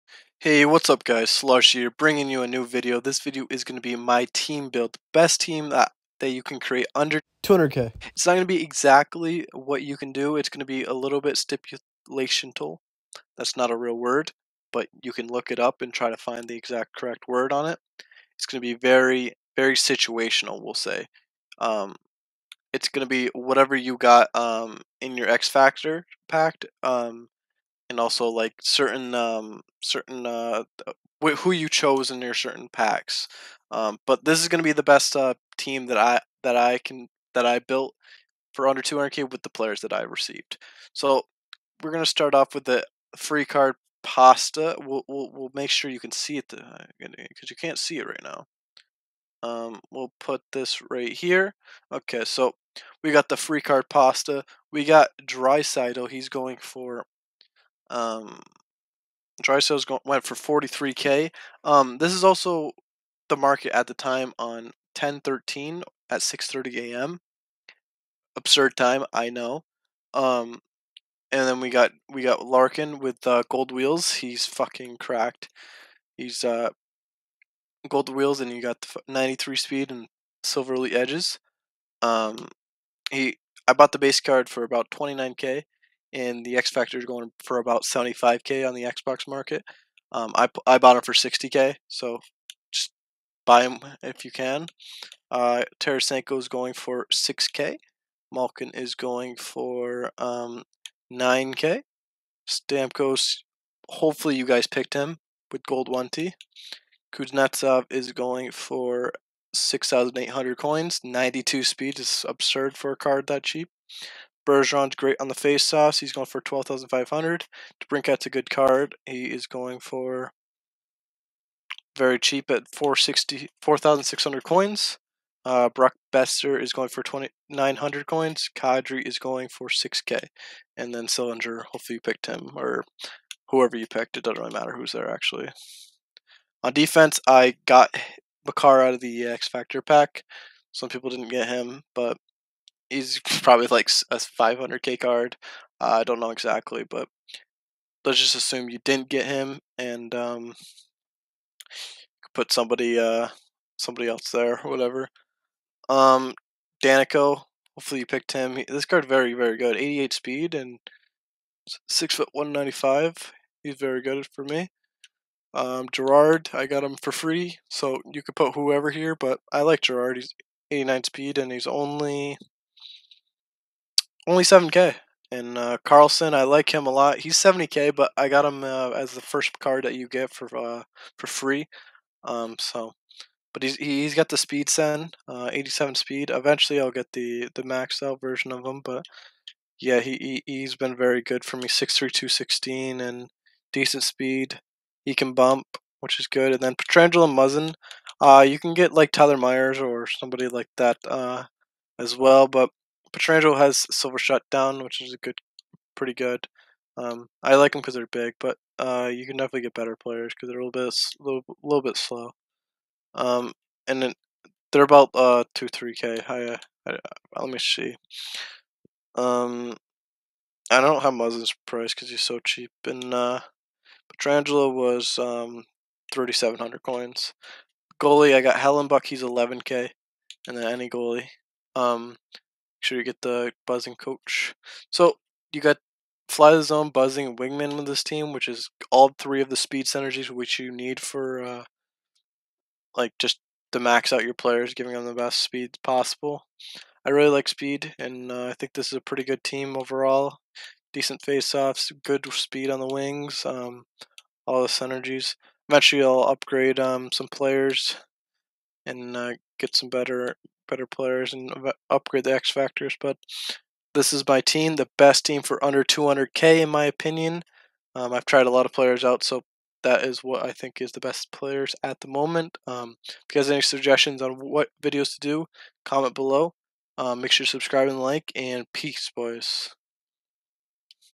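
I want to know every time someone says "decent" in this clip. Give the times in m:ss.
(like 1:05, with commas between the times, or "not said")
3:13, 4:10.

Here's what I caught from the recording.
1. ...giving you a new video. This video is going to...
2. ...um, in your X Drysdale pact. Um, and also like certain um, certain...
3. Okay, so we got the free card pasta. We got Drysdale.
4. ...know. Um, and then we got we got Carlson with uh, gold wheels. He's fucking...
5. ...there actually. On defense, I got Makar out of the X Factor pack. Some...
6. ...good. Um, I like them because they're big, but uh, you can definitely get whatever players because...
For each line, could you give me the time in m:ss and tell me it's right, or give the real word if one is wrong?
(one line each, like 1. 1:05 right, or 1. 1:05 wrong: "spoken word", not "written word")
1. 0:01 wrong: "bringing", not "giving"
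2. 0:24 wrong: "Factor", not "Drysdale"
3. 0:51 right
4. 1:09 wrong: "Larkin", not "Carlson"
5. 2:14 right
6. 3:26 wrong: "better", not "whatever".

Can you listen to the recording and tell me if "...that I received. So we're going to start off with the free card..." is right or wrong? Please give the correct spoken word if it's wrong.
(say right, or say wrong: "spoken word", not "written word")
right.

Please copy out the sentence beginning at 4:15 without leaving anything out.
Eventually, I'll upgrade um, some players and uh, get some better better players and upgrade the X factors.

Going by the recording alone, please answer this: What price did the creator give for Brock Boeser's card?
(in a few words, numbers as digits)
2,900 coins.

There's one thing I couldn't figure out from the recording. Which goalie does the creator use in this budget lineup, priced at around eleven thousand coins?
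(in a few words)
Hellebuyck.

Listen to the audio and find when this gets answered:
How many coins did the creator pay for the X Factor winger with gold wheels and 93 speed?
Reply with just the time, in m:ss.
1:31.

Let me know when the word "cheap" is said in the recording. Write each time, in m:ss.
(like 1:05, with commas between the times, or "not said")
1:53, 2:02, 3:42.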